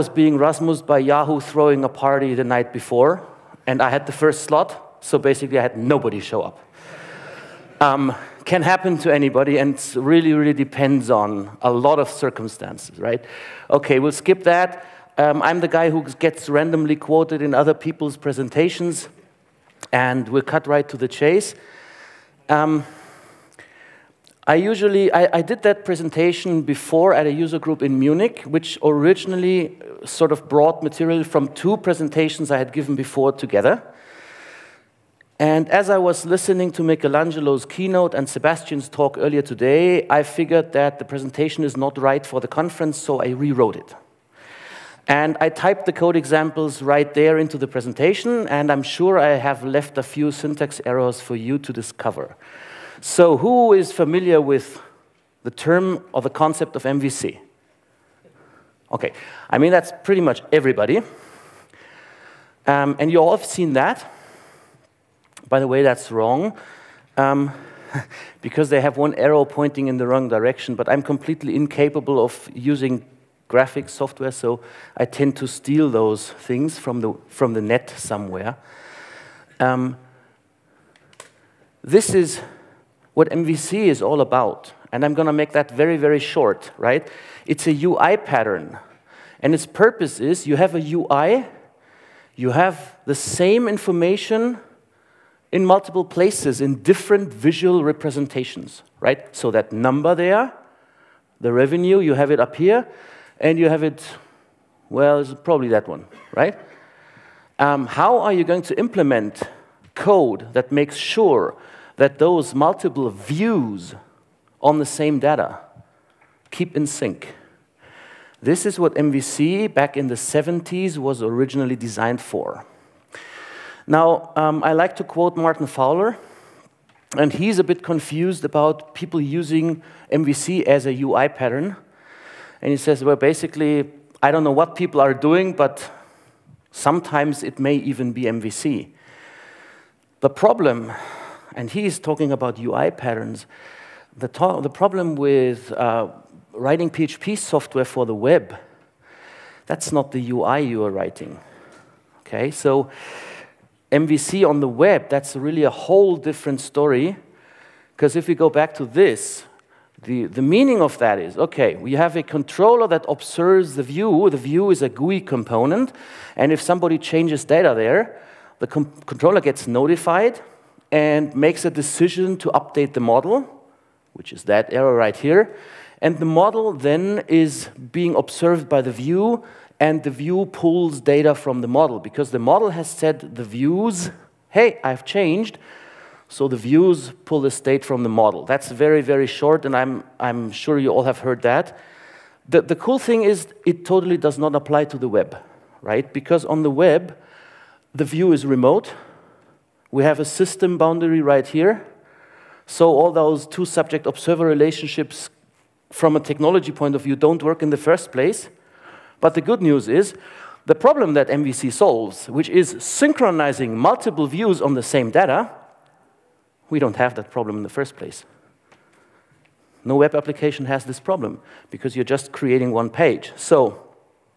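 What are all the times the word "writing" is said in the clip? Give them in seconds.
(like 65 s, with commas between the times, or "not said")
146 s, 150 s.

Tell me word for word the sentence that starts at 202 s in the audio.
So all those two subject-observer relationships from a technology point of view don't work in the first place.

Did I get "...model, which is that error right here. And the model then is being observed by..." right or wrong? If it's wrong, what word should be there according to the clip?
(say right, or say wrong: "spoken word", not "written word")
right.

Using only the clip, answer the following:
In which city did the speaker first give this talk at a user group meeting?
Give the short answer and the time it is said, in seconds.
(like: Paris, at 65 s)
Munich, at 27 s.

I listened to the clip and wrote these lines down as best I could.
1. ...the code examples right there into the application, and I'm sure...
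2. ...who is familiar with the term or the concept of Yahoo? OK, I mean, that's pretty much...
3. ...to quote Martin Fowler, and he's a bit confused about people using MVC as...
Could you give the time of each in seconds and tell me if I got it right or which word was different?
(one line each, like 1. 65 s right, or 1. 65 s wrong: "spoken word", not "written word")
1. 45 s wrong: "presentation", not "application"
2. 53 s wrong: "MVC", not "Yahoo"
3. 124 s right.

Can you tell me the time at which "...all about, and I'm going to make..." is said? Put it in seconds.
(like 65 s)
84 s.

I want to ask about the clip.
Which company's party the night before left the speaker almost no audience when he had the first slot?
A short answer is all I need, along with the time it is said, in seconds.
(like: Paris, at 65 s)
Yahoo, at 0 s.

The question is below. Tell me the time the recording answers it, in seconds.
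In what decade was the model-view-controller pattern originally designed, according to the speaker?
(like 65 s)
120 s.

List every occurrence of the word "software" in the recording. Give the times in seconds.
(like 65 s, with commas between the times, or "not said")
73 s, 147 s.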